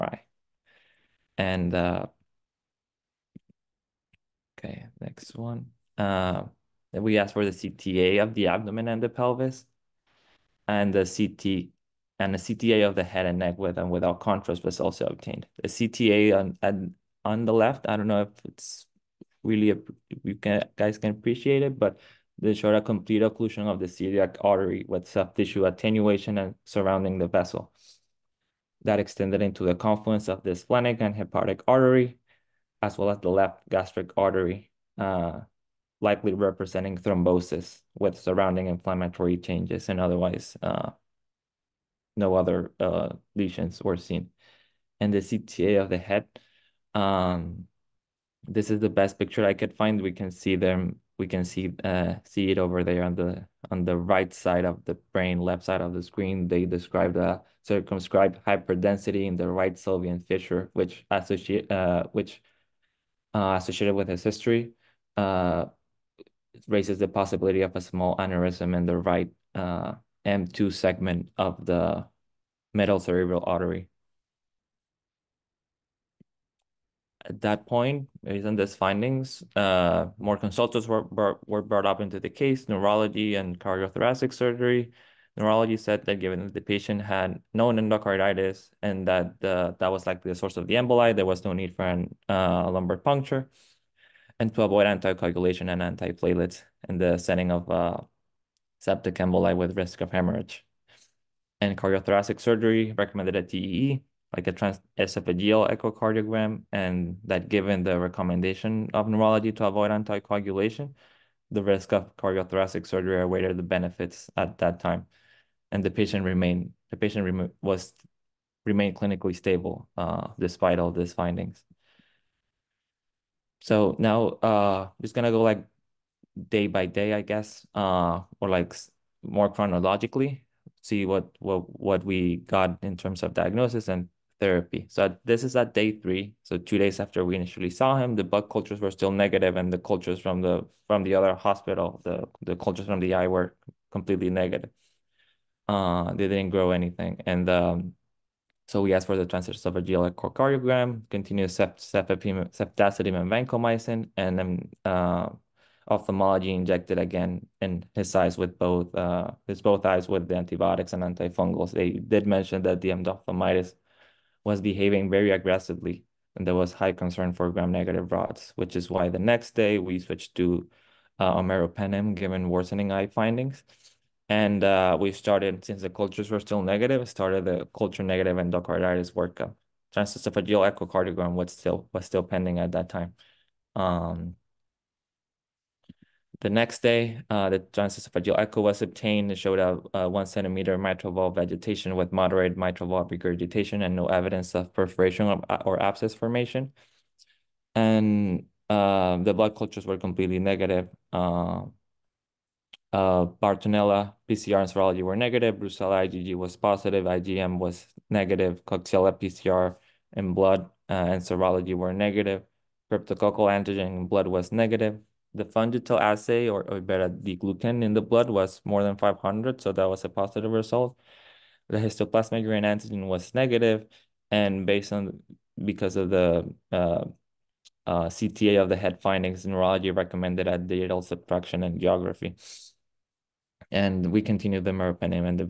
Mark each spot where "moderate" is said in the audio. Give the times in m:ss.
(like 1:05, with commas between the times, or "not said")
3:12.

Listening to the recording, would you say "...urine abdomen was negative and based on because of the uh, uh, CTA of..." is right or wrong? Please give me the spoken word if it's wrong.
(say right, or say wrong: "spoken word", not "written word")
wrong: "antigen", not "abdomen".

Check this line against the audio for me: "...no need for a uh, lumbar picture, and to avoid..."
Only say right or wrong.
wrong.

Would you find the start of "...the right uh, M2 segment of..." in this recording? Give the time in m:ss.
1:08.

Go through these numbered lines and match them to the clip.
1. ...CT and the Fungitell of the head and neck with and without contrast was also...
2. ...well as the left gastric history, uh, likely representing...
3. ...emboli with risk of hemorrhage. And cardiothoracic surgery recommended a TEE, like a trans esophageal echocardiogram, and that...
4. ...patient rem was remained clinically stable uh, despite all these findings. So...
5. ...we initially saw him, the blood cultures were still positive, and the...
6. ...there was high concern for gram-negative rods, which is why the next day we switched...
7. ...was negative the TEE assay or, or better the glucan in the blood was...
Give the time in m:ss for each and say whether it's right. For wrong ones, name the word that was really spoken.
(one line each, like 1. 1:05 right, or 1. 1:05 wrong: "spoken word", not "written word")
1. 0:11 wrong: "CTA", not "Fungitell"
2. 0:32 wrong: "artery", not "history"
3. 1:39 right
4. 1:56 right
5. 2:17 wrong: "negative", not "positive"
6. 2:46 right
7. 3:34 wrong: "Fungitell", not "TEE".